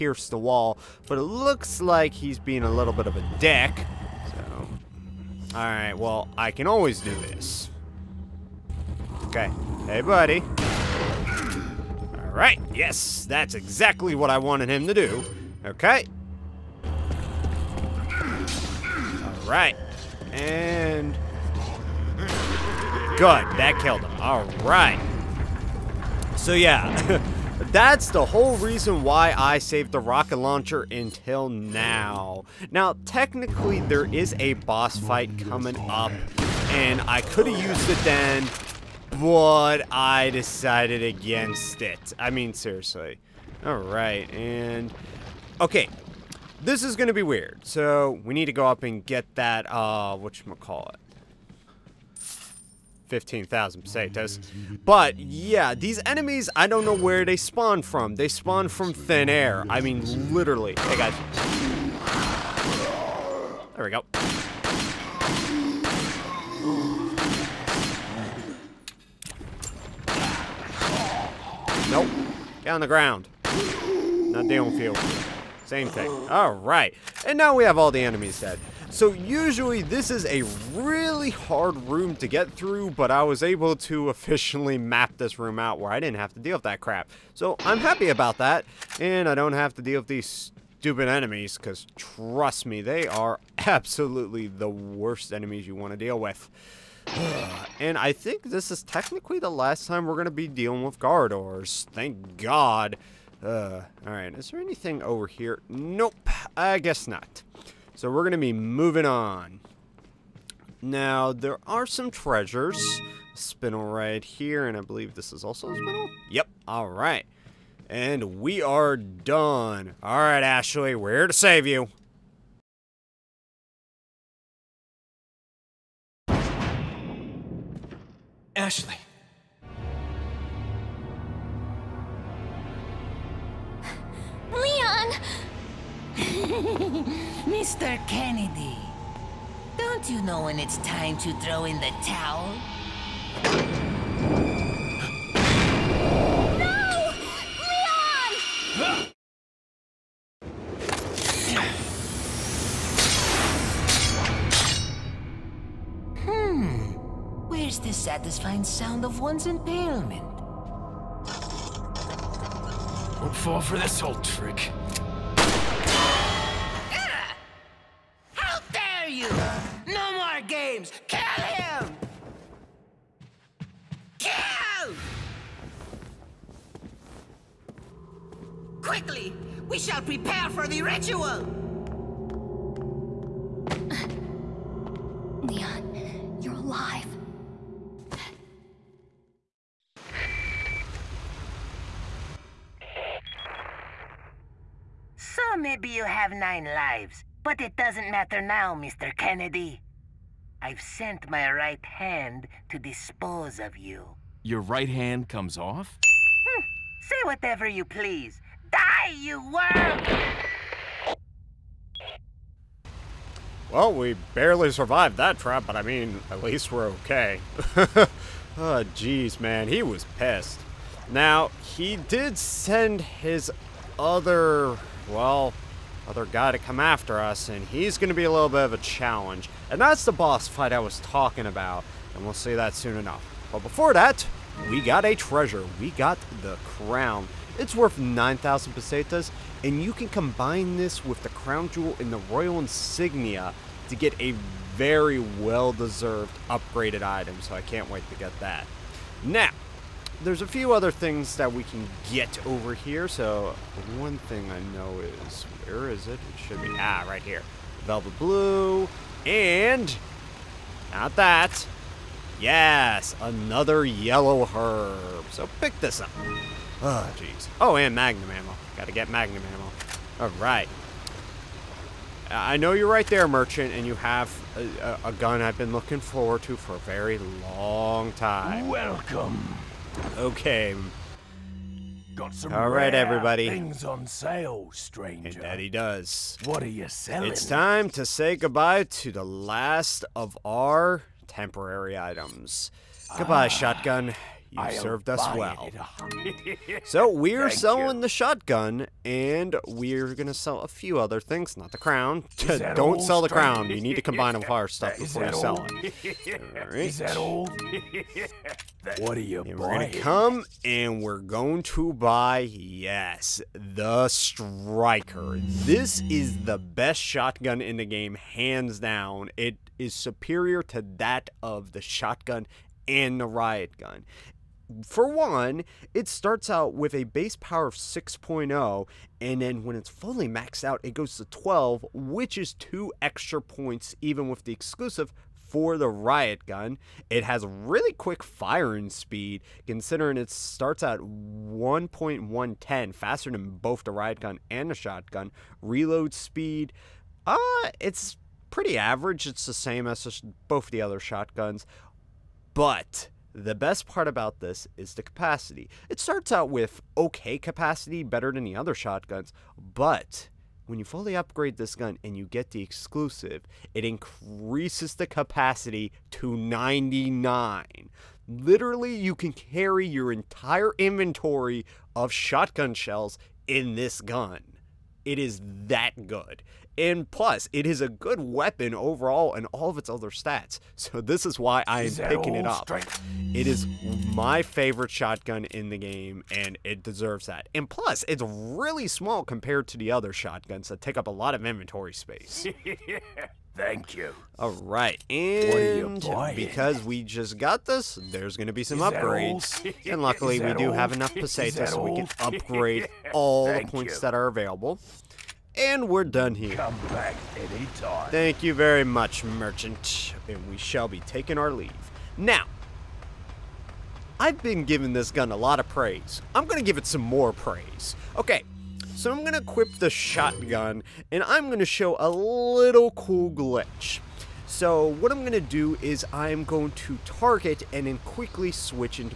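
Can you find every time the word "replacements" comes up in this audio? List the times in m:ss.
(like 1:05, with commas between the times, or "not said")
not said.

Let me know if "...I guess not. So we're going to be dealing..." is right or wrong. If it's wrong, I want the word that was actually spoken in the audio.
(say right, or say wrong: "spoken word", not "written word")
wrong: "moving", not "dealing".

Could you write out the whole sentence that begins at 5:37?
It has really quick firing speed, considering it starts at 1.110, faster than both the riot gun and the shotgun.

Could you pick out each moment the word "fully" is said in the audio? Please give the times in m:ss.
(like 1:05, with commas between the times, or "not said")
5:29, 6:00.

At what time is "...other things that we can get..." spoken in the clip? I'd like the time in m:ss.
4:10.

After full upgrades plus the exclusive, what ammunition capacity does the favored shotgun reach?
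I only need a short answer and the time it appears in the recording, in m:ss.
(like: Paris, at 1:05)
99, at 6:06.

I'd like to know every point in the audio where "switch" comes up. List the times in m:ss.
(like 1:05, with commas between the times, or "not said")
7:08.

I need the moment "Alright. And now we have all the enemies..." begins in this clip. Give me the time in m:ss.
1:16.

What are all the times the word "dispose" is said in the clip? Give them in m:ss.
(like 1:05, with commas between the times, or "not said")
3:22.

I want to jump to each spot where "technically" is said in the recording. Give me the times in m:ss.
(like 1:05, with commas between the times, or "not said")
0:33, 1:38.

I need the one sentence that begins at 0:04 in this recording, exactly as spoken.
So, alright, well, I can always do this.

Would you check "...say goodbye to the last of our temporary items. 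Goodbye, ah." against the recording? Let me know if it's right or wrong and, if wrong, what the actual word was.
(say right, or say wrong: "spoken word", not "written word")
right.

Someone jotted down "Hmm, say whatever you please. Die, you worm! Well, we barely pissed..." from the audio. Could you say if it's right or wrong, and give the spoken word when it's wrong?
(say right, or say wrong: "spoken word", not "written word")
wrong: "survived", not "pissed".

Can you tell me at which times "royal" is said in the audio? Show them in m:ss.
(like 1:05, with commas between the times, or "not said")
4:02.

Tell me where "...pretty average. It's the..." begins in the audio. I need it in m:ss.
5:48.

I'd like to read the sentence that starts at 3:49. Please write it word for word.
And that's the boss fight I was talking about, and we'll see that soon enough.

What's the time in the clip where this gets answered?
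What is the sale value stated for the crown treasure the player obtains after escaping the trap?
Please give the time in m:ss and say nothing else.
3:57.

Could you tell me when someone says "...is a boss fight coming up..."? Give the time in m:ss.
0:34.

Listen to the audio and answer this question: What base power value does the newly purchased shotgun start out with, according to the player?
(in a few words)
6.0.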